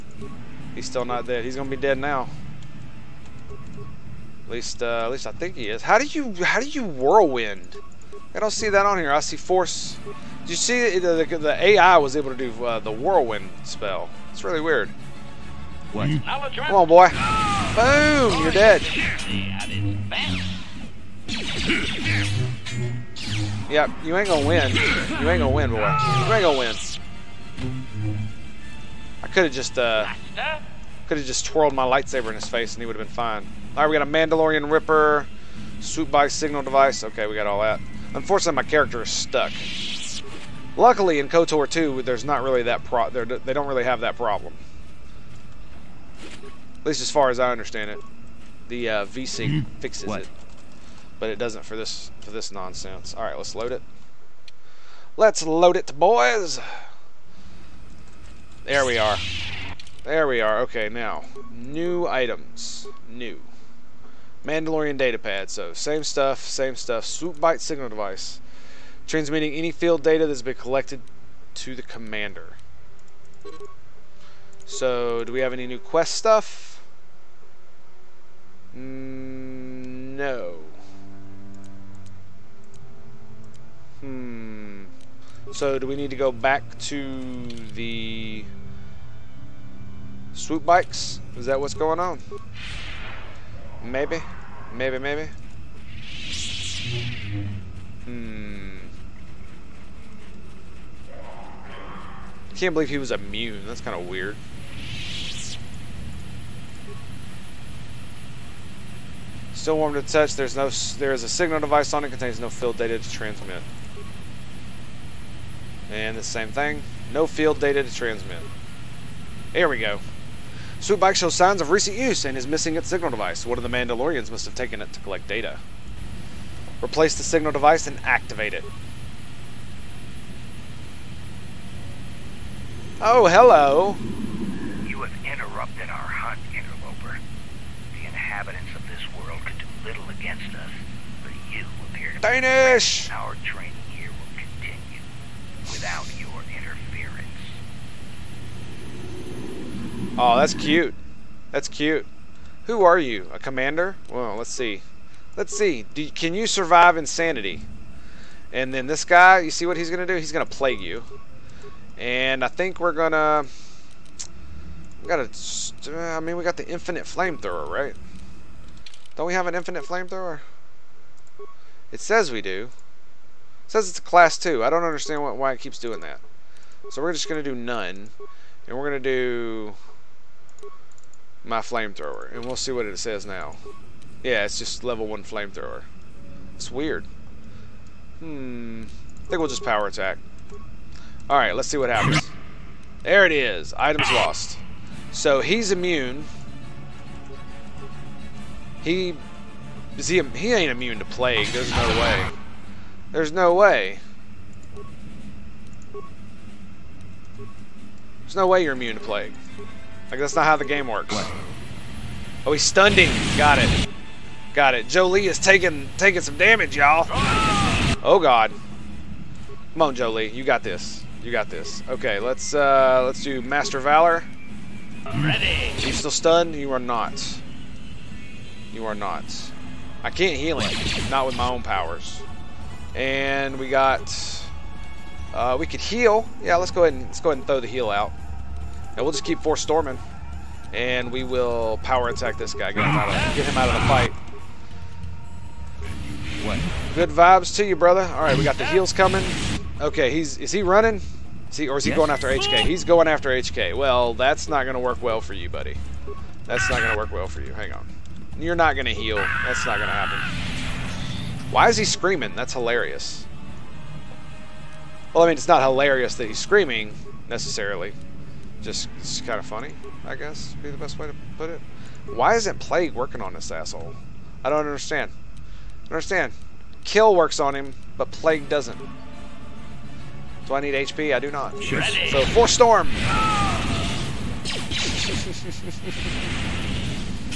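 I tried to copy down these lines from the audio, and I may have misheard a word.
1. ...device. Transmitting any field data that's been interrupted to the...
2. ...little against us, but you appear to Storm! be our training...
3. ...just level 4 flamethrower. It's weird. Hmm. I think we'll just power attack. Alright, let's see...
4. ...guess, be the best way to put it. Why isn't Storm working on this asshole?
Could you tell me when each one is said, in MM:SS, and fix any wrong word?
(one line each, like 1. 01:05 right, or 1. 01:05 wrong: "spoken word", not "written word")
1. 01:07 wrong: "collected", not "interrupted"
2. 02:19 wrong: "Danish", not "Storm"
3. 03:04 wrong: "1", not "4"
4. 04:30 wrong: "Plague", not "Storm".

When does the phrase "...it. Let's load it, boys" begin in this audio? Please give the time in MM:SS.
00:53.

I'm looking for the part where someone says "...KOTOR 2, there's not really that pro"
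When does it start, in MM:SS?
00:41.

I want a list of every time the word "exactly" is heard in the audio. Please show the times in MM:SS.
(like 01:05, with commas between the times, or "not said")
not said.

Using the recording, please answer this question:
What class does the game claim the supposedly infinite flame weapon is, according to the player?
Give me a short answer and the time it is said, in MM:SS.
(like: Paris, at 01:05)
Class 2, at 02:54.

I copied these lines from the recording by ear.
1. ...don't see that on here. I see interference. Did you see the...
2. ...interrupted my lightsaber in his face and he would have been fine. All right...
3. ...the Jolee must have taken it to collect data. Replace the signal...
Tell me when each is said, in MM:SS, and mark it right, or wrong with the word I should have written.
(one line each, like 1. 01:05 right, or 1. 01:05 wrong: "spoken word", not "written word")
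1. 00:08 wrong: "force", not "interference"
2. 00:31 wrong: "twirled", not "interrupted"
3. 02:03 wrong: "Mandalorians", not "Jolee".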